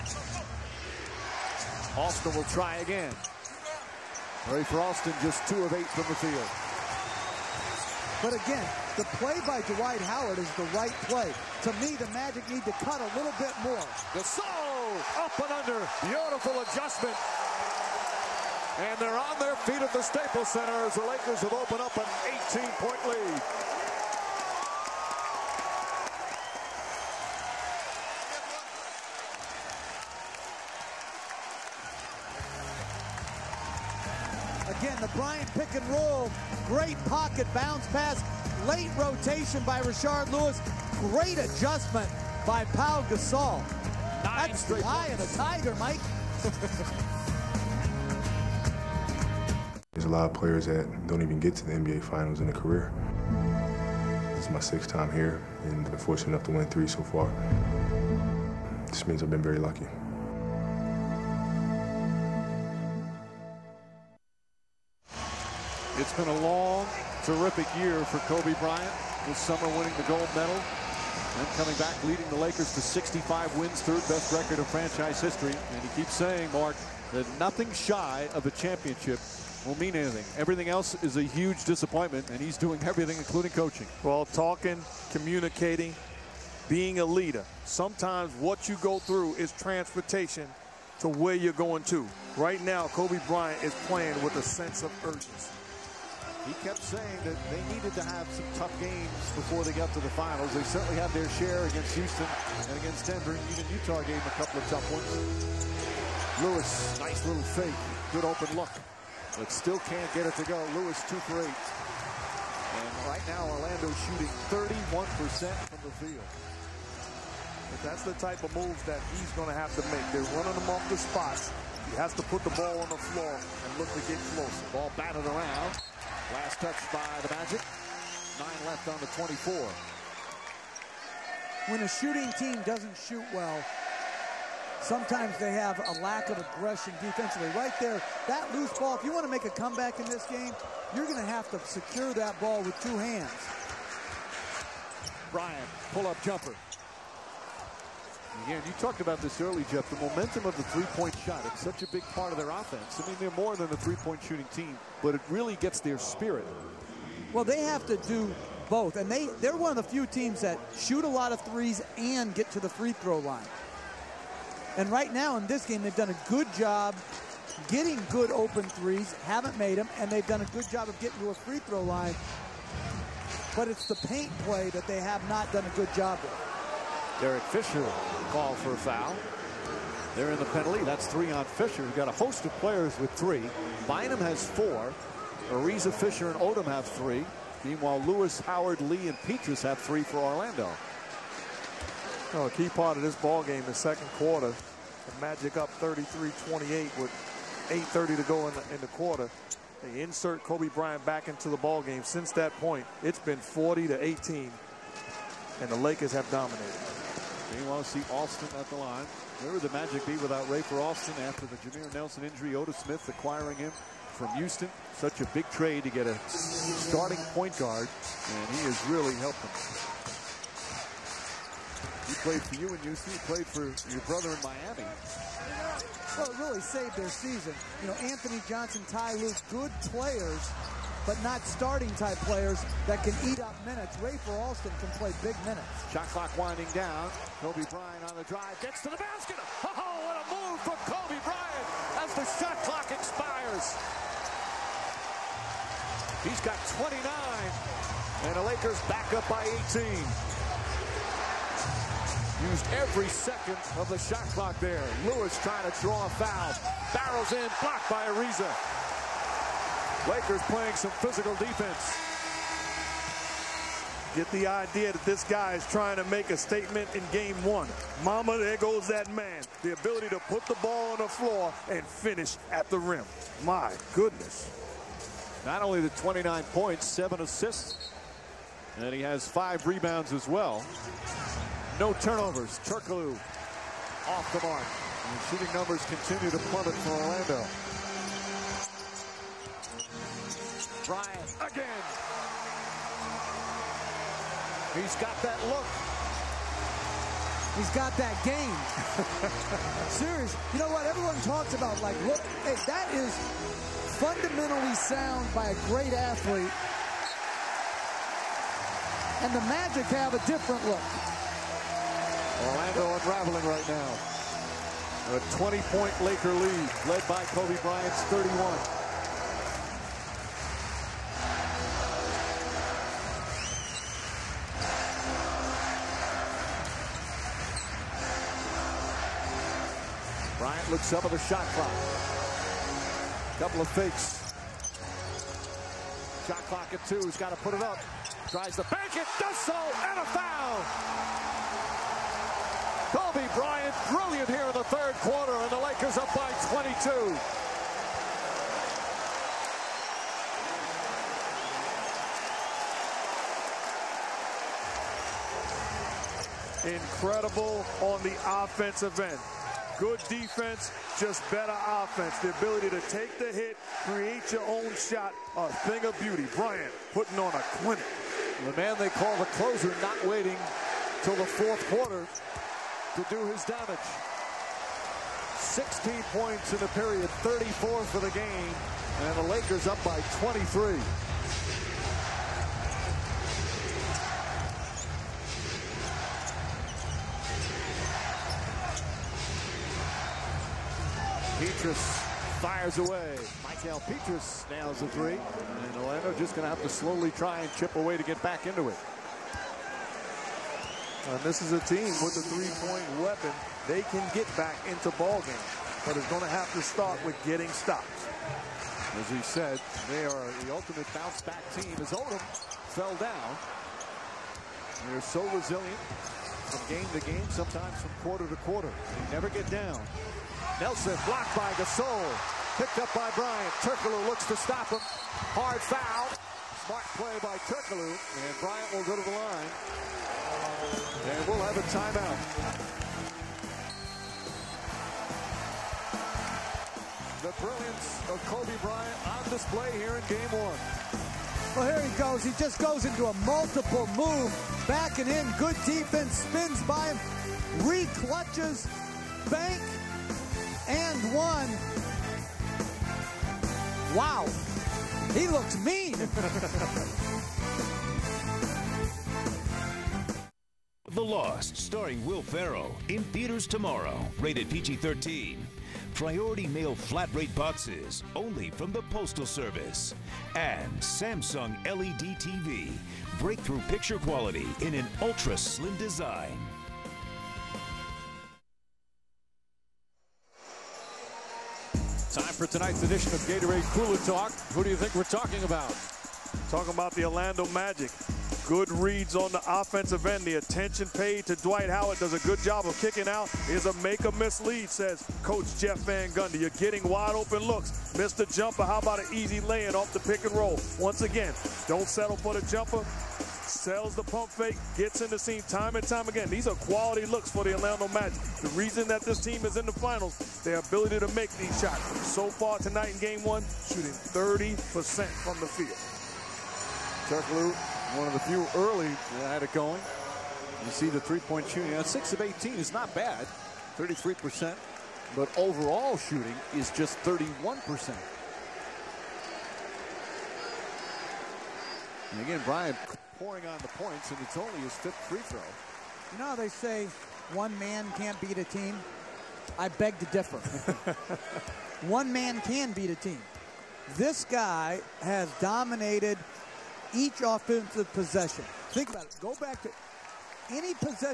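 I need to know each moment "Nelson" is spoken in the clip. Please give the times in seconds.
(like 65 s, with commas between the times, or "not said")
211 s, 420 s.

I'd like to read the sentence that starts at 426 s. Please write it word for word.
Smart play by Turkoglu, And Bryant will go to the line.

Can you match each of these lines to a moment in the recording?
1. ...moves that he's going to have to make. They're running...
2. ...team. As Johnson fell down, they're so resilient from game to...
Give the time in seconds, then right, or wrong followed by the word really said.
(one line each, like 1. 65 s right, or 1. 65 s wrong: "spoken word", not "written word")
1. 118 s right
2. 411 s wrong: "Odom", not "Johnson".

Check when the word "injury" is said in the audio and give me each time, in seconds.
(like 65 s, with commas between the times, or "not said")
212 s.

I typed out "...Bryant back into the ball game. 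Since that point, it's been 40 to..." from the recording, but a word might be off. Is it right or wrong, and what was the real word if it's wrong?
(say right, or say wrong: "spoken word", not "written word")
right.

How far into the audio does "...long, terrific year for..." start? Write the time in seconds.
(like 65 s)
66 s.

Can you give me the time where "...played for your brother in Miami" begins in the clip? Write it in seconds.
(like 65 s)
223 s.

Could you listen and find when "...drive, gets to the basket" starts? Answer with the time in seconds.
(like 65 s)
238 s.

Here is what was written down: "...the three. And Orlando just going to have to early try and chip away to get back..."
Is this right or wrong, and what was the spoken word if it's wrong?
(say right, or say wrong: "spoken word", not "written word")
wrong: "slowly", not "early".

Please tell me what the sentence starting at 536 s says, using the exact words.
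You know they say one man can't beat a team?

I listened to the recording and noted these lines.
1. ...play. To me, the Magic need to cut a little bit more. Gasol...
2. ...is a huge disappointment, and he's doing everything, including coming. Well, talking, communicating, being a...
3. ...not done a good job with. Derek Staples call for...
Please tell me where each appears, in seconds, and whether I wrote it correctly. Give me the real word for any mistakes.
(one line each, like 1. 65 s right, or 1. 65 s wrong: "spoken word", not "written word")
1. 11 s right
2. 81 s wrong: "coaching", not "coming"
3. 175 s wrong: "Fisher", not "Staples".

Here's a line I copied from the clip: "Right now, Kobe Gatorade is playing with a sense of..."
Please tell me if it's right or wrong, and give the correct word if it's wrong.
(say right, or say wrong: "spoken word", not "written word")
wrong: "Bryant", not "Gatorade".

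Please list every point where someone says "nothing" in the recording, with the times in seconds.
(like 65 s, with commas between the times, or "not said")
77 s.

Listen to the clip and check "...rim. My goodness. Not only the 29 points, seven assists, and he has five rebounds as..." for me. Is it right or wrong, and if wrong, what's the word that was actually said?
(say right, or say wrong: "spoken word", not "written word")
right.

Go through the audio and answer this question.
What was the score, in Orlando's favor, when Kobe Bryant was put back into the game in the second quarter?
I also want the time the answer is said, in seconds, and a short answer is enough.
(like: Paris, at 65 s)
33-28, at 195 s.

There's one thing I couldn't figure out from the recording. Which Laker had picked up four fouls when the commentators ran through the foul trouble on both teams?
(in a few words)
Bynum.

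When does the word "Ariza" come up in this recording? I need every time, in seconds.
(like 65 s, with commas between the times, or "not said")
185 s, 258 s.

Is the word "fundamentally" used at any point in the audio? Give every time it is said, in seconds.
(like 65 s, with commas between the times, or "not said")
304 s.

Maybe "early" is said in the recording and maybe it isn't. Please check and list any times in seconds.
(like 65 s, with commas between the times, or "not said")
149 s, 518 s.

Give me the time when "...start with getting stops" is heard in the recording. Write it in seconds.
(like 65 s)
406 s.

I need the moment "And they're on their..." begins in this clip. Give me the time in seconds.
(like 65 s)
18 s.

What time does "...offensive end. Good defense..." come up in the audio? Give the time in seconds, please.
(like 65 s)
358 s.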